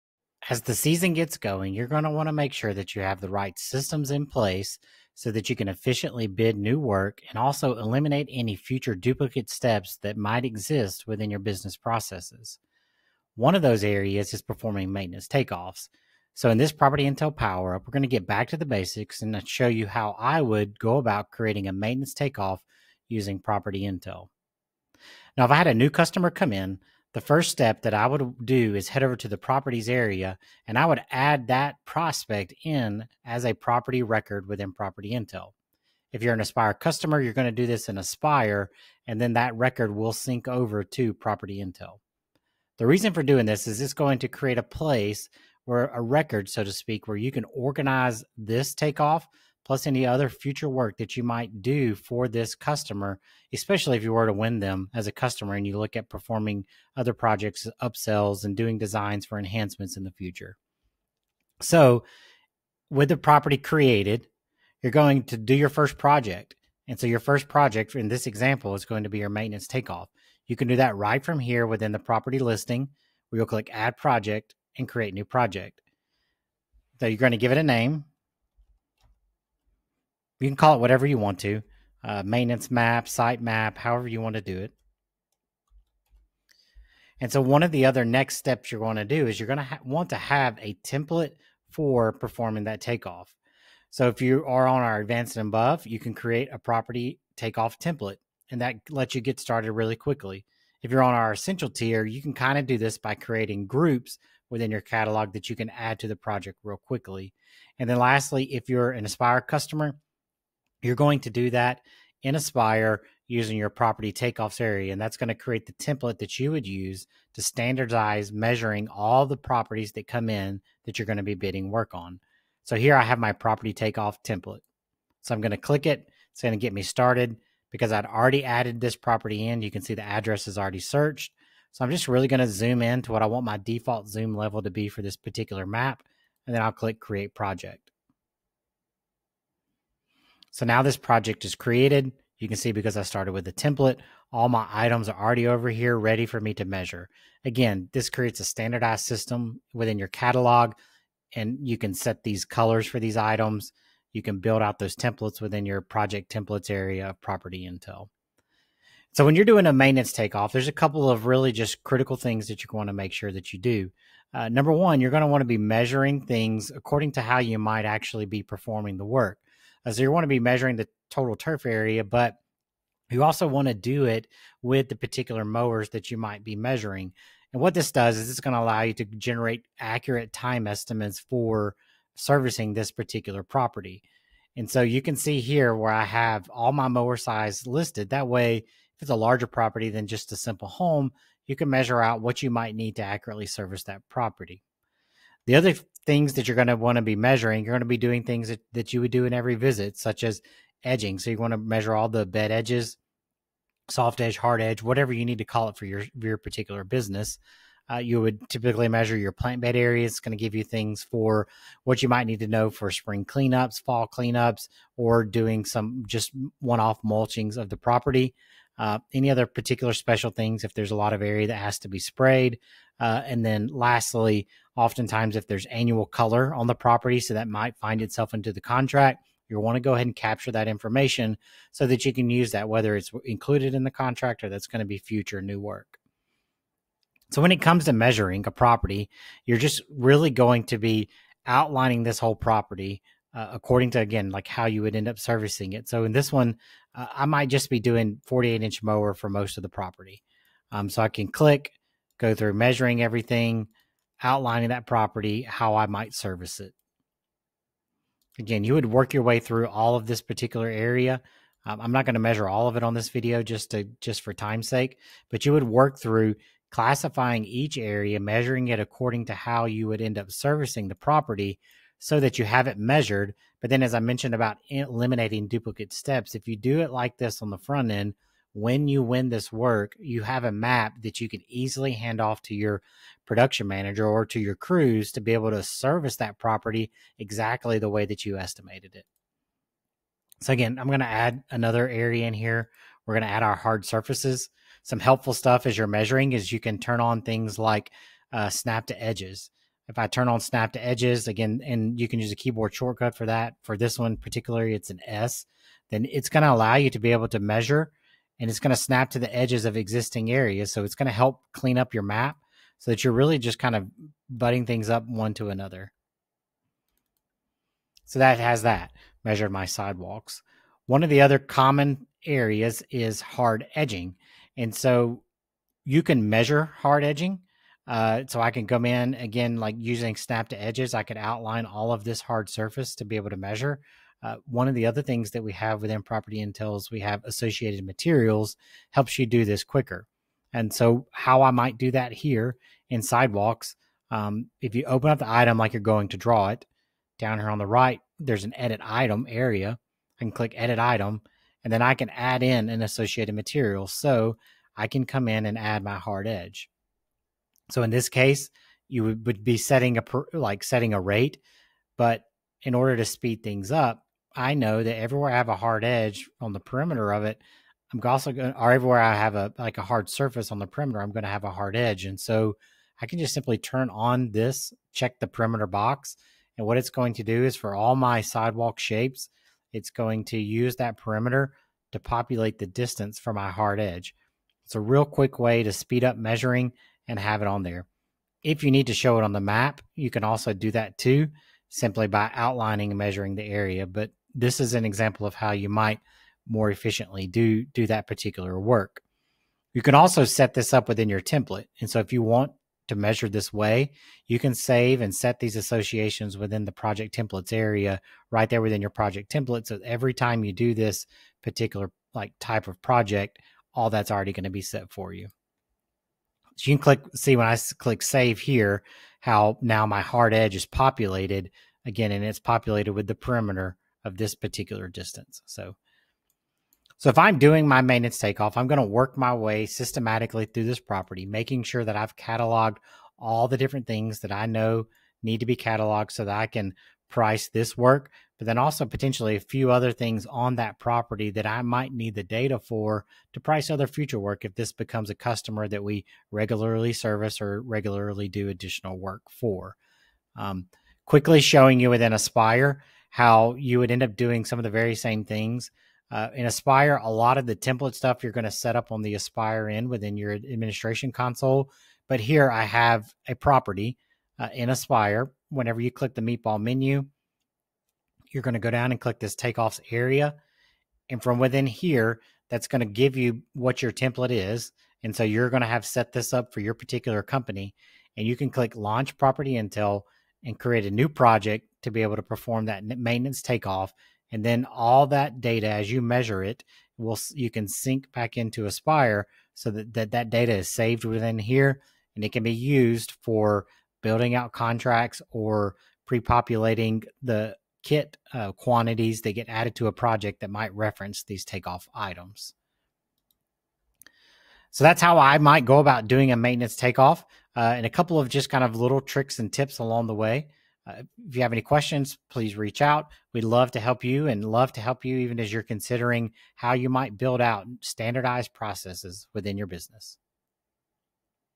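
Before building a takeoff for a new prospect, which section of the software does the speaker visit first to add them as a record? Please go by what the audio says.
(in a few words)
properties area.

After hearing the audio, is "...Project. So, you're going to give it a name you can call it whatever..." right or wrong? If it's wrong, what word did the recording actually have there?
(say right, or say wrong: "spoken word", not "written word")
right.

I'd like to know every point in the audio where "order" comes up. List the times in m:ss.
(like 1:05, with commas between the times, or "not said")
6:02.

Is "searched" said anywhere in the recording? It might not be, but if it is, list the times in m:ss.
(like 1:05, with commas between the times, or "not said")
2:10.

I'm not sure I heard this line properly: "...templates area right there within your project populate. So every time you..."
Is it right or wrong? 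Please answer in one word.
wrong.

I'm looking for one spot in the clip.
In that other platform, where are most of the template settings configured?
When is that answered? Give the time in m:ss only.
7:40.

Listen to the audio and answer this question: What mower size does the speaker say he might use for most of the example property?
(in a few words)
48 inch.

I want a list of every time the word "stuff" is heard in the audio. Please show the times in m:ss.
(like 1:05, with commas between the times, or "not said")
4:55, 7:37.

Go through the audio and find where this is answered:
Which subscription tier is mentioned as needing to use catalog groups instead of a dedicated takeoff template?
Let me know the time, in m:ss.
1:41.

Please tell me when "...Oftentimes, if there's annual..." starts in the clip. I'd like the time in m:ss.
3:44.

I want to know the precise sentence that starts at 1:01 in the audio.
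So, with the property created, you're going to do your first project.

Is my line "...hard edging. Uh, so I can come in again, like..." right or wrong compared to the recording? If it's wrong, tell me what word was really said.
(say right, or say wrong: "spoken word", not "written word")
right.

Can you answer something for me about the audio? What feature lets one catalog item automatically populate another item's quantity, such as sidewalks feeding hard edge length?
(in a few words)
associated materials.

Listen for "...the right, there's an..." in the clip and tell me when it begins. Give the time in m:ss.
5:47.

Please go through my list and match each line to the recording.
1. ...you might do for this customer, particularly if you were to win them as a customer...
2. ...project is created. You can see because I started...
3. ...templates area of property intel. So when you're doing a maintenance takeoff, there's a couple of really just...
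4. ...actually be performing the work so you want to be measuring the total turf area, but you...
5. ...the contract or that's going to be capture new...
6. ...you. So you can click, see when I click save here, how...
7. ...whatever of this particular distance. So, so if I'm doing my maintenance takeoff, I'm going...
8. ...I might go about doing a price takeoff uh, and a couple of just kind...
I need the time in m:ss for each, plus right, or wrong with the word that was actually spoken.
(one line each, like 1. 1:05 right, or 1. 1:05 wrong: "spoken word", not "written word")
1. 0:51 wrong: "especially", not "particularly"
2. 2:20 right
3. 2:36 right
4. 2:47 right
5. 3:53 wrong: "future", not "capture"
6. 6:55 right
7. 7:03 wrong: "perimeter", not "whatever"
8. 8:25 wrong: "maintenance", not "price".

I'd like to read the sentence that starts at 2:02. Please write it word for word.
So here I have my property takeoff template.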